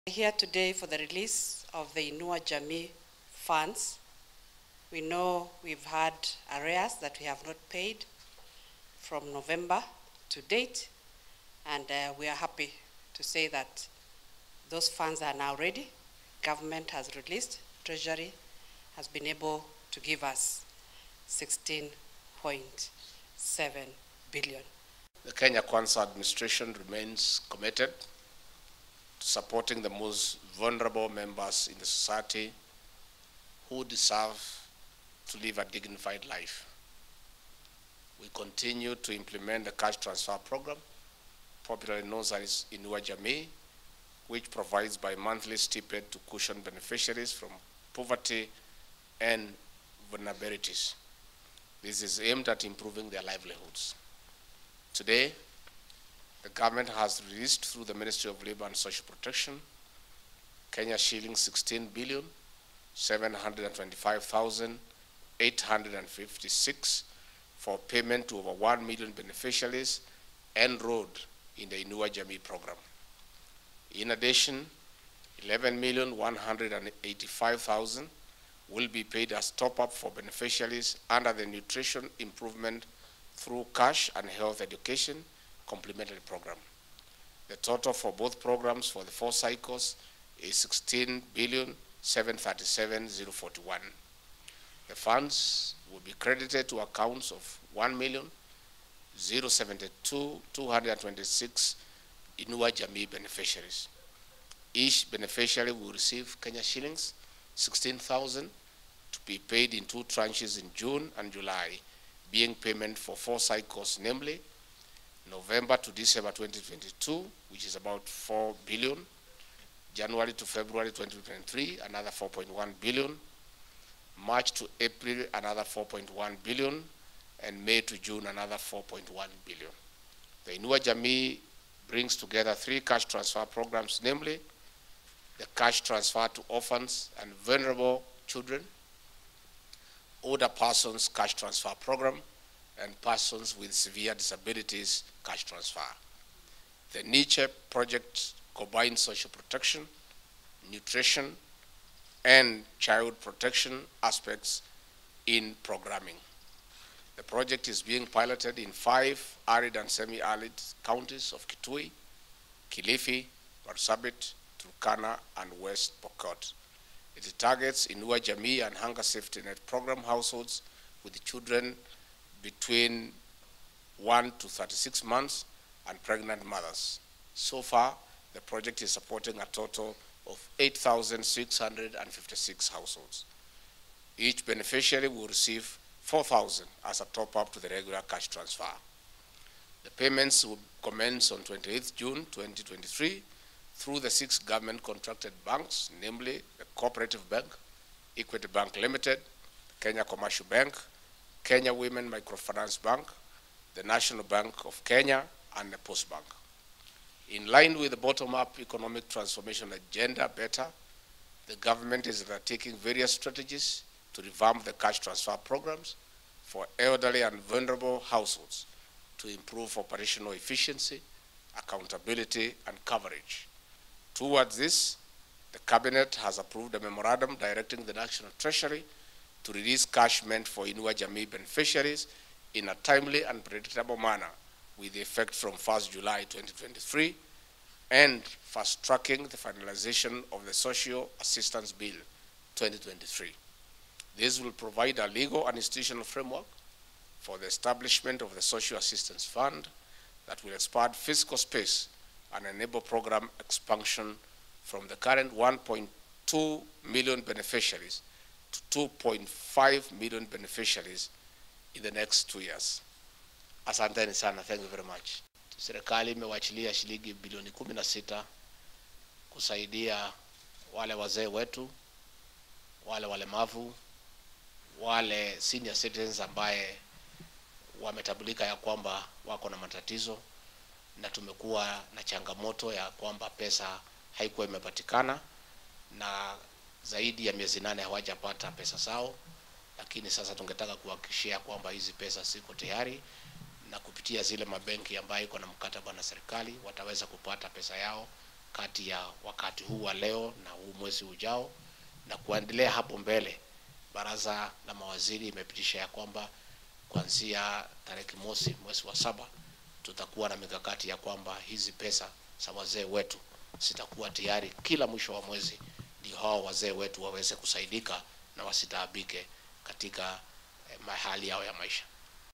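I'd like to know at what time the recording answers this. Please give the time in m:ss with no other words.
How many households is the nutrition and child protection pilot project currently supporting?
3:00.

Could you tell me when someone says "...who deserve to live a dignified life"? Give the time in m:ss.
0:33.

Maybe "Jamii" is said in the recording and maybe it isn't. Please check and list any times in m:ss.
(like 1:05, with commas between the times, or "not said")
0:02, 0:42, 1:12, 1:42, 2:10, 2:48, 3:50.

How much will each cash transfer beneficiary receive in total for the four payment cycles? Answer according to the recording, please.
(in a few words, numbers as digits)
16,000 shillings.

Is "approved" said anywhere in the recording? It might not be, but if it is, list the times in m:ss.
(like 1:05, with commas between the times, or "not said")
3:46.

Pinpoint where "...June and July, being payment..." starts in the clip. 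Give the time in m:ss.
1:50.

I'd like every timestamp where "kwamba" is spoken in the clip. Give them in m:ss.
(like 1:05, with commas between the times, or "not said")
4:38, 4:42, 4:51, 5:05, 5:10.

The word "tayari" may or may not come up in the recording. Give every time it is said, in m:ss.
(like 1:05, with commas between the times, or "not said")
4:52, 5:14.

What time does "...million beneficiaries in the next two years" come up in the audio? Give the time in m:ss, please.
4:19.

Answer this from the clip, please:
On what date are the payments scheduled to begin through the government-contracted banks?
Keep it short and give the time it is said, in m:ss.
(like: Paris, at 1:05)
28 June 2023, at 3:11.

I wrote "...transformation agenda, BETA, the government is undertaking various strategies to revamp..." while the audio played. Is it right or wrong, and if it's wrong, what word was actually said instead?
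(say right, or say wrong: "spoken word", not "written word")
right.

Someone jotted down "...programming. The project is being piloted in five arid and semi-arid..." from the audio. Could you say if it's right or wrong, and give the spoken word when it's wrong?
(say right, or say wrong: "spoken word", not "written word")
right.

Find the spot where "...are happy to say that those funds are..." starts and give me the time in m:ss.
0:12.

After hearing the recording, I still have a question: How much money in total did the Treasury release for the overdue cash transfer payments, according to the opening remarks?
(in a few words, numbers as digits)
16.7 billion.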